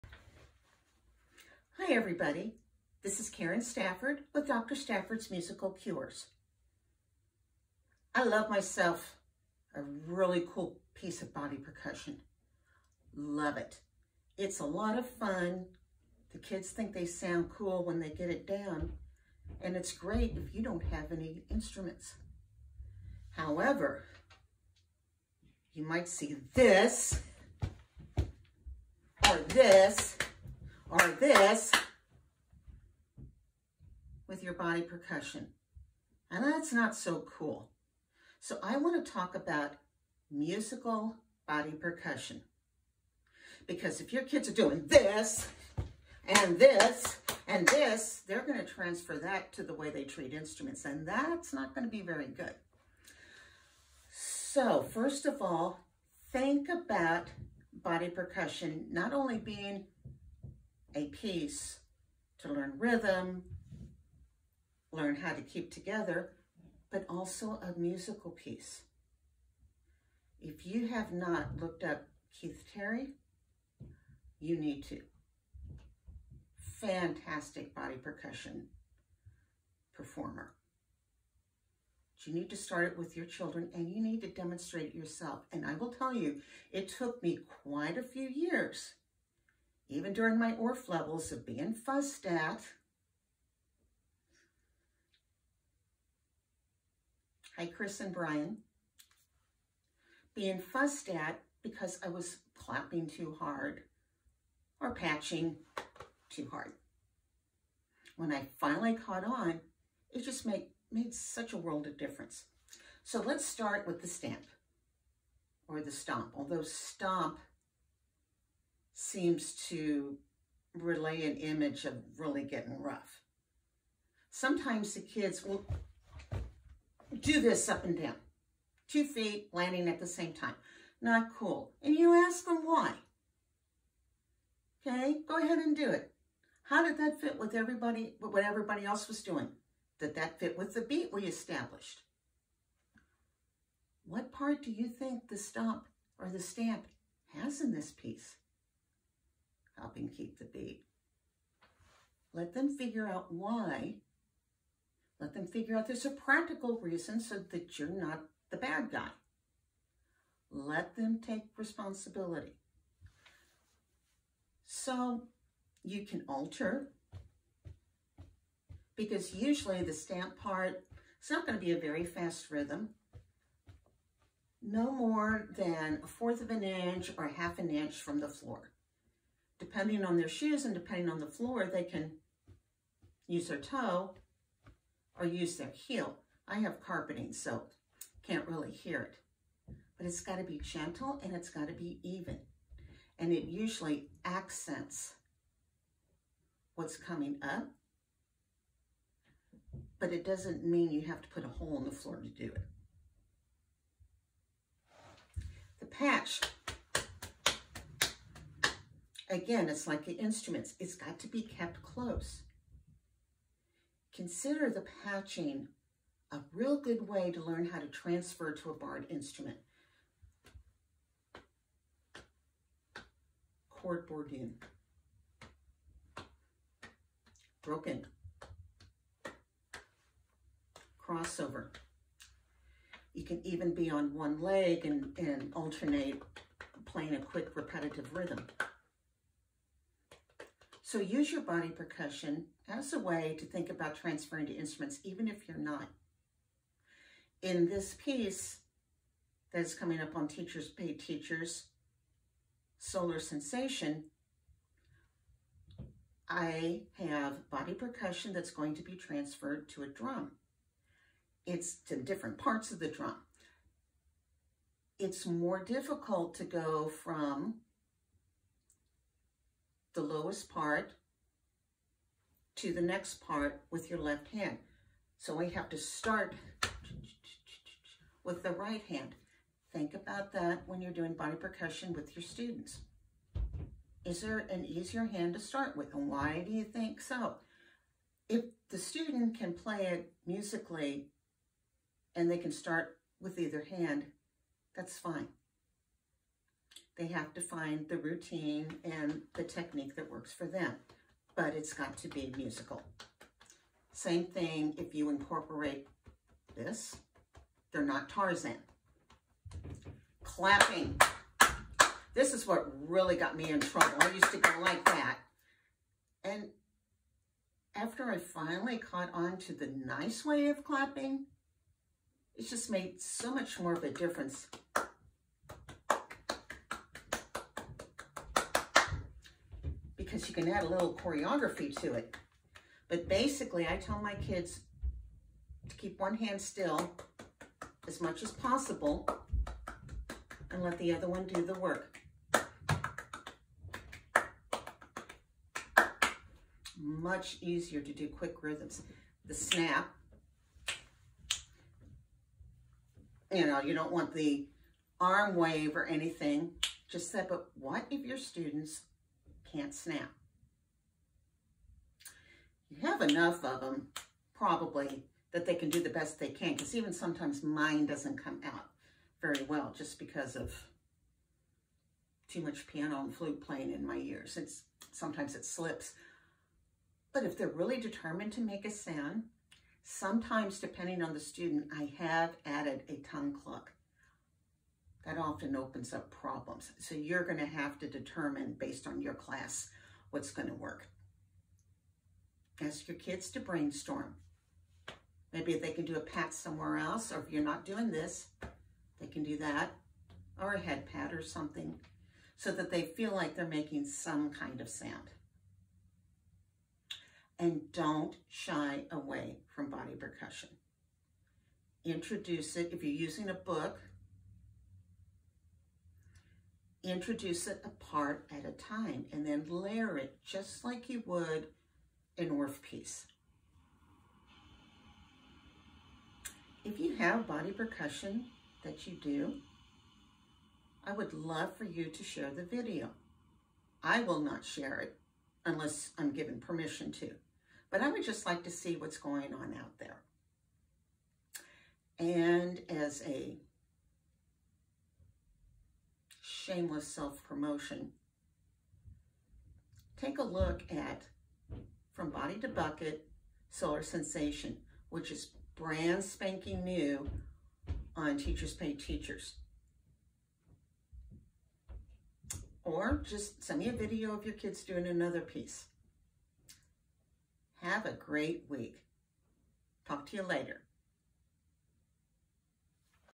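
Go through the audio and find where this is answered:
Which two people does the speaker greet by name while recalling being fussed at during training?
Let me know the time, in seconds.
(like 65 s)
97 s.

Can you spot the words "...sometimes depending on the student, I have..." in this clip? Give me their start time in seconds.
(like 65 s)
379 s.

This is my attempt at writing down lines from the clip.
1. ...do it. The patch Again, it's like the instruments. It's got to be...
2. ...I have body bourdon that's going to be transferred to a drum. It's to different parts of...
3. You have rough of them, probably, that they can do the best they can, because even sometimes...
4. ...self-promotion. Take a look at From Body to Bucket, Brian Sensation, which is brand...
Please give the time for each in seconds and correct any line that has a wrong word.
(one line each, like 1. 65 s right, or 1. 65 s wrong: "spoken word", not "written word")
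1. 202 s right
2. 256 s wrong: "percussion", not "bourdon"
3. 362 s wrong: "enough", not "rough"
4. 446 s wrong: "Solar", not "Brian".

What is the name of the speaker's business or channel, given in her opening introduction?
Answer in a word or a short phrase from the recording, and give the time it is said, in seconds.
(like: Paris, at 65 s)
Dr. Stafford's Musical Cures, at 4 s.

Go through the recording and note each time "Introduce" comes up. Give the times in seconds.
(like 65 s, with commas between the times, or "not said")
411 s, 416 s.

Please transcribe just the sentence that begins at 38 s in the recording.
So I want to talk about musical body percussion.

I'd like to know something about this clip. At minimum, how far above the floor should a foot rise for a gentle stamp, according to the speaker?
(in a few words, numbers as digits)
1/4 inch.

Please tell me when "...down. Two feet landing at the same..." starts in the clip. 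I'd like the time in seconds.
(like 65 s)
128 s.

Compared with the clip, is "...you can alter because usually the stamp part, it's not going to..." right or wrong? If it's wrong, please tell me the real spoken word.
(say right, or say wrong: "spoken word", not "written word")
right.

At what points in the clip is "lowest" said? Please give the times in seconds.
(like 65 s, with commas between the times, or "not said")
270 s.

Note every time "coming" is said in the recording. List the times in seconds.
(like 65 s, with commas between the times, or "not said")
196 s, 249 s.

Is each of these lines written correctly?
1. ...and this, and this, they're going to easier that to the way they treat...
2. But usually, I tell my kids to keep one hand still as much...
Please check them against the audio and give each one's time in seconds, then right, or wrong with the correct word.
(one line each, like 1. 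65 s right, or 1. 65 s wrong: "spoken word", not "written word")
1. 46 s wrong: "transfer", not "easier"
2. 332 s wrong: "basically", not "usually".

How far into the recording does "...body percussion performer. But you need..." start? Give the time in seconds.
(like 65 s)
77 s.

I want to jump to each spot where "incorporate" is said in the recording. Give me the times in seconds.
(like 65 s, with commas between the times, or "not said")
305 s.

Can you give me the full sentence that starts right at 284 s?
Is there an easier hand to start with?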